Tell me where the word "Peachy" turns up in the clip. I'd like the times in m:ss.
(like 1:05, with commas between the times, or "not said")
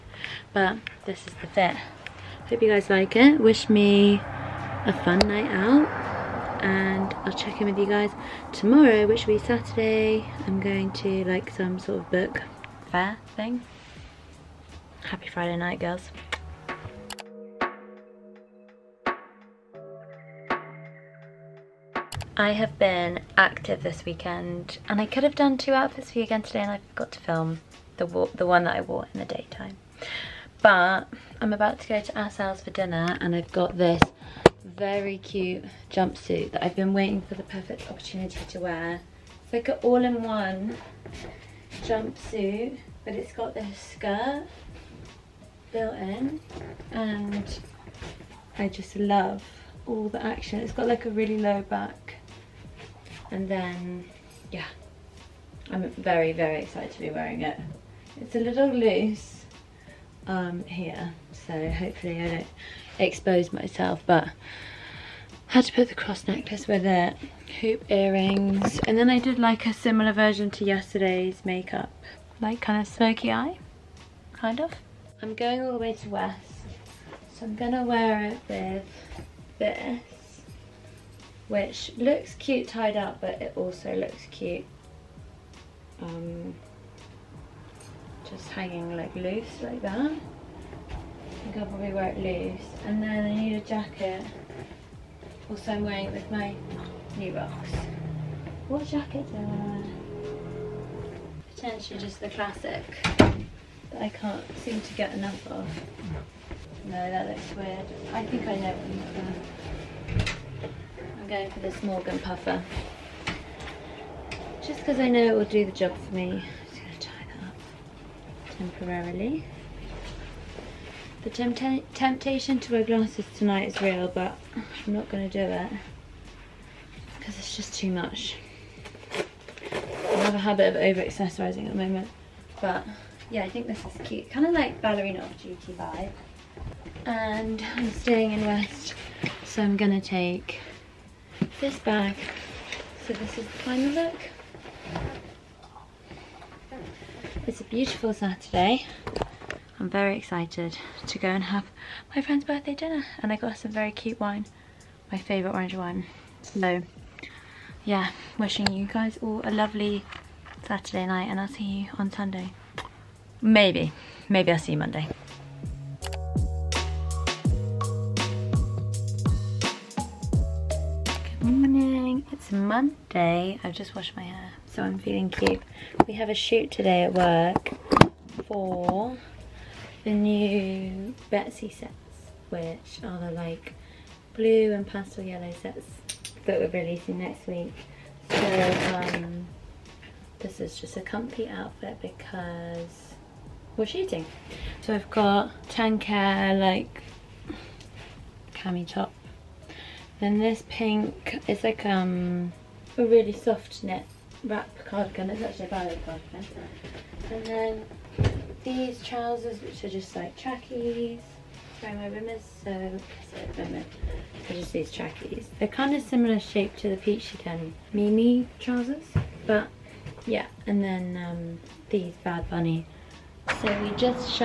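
3:36.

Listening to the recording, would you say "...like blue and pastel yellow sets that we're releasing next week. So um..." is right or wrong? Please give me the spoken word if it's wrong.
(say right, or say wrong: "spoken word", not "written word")
right.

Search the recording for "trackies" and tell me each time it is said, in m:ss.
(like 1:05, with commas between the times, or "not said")
3:30, 3:34.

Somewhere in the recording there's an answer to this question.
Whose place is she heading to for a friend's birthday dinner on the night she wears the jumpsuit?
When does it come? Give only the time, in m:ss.
0:32.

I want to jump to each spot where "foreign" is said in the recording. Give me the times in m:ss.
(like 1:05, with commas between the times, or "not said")
not said.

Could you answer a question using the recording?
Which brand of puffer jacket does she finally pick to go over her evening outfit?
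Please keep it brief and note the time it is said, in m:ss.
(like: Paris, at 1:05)
Morgan, at 1:51.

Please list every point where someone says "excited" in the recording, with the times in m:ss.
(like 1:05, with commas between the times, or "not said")
0:56, 2:30.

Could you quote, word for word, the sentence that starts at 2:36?
So yeah, wishing you guys all a lovely Saturday night and I'll see you on Sunday.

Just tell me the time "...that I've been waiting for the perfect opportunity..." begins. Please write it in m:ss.
0:36.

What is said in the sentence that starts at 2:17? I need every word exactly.
And I'm staying in West, so I'm going to take this bag.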